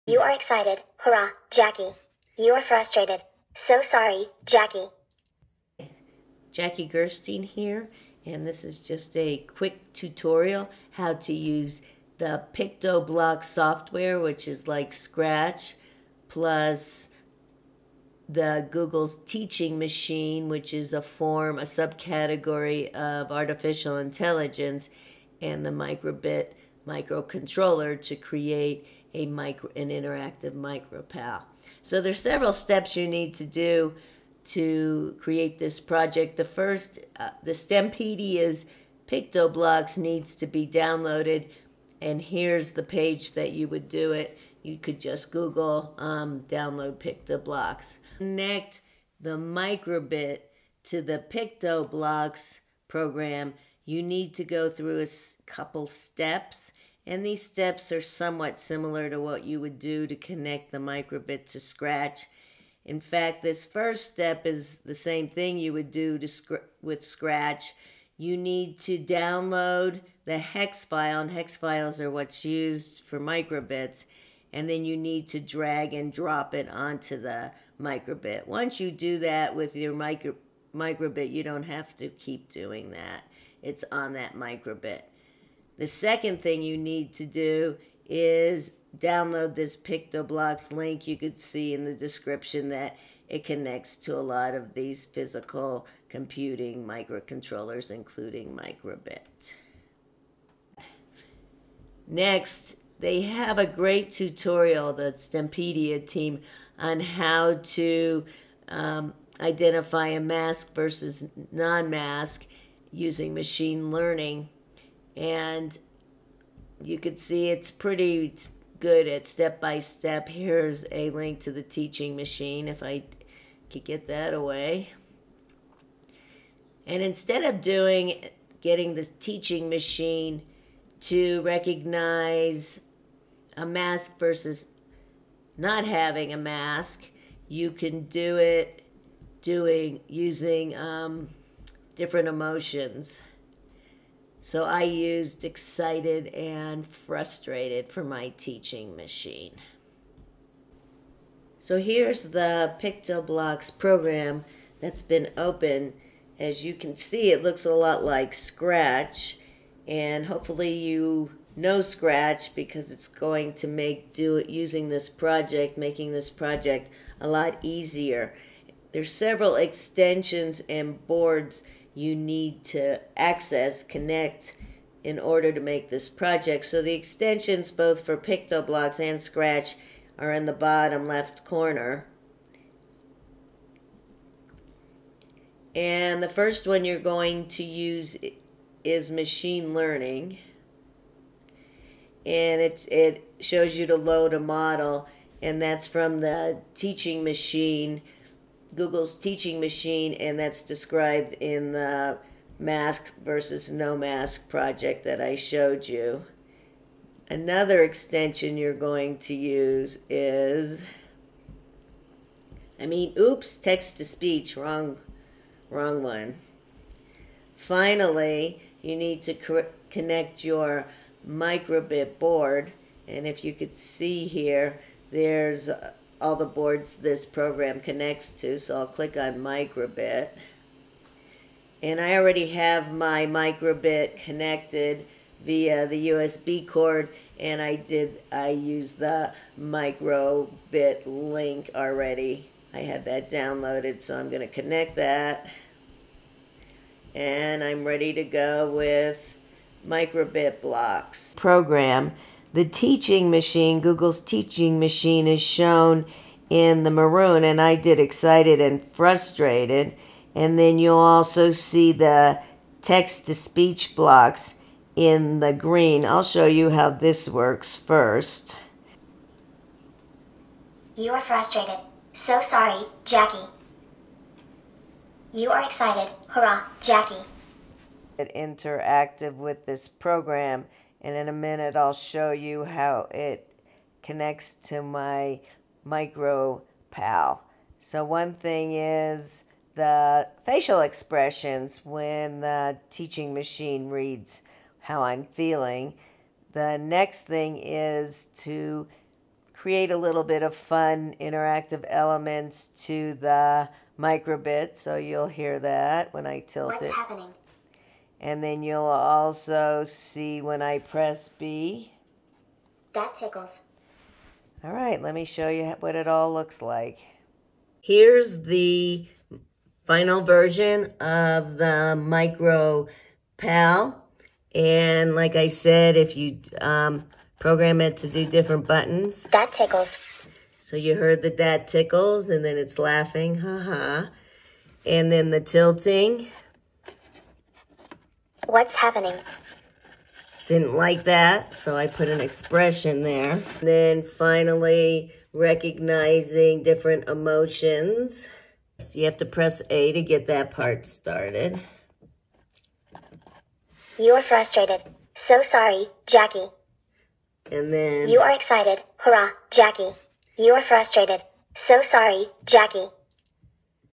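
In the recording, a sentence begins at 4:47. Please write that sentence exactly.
So one thing is the facial expressions when the teaching machine reads how I'm feeling.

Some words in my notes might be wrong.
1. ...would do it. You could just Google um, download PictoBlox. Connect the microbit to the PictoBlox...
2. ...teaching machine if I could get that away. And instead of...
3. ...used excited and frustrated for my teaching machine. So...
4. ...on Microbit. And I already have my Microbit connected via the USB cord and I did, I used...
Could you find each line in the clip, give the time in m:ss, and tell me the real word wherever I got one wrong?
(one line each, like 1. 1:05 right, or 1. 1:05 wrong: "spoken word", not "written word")
1. 0:43 right
2. 2:01 right
3. 2:24 right
4. 3:49 right.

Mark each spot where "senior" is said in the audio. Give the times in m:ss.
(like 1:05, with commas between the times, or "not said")
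not said.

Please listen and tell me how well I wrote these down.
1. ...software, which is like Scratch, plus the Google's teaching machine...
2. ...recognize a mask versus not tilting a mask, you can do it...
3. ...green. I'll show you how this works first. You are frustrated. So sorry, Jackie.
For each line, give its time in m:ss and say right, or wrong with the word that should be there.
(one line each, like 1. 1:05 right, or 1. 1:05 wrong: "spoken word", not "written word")
1. 0:13 right
2. 2:11 wrong: "having", not "tilting"
3. 4:25 right.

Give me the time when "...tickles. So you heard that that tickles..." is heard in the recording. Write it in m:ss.
5:29.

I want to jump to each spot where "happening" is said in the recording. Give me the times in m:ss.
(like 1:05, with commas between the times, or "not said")
5:06, 5:38.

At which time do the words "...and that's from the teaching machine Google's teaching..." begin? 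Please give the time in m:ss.
3:15.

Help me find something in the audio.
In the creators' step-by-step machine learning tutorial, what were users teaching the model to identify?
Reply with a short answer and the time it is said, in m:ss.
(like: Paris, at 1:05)
mask versus non-mask, at 1:50.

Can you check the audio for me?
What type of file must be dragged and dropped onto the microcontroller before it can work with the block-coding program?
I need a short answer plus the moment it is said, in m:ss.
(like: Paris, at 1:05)
hex file, at 1:10.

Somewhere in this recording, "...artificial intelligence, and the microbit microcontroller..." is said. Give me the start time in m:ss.
0:23.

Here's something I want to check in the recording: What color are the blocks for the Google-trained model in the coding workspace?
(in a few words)
maroon.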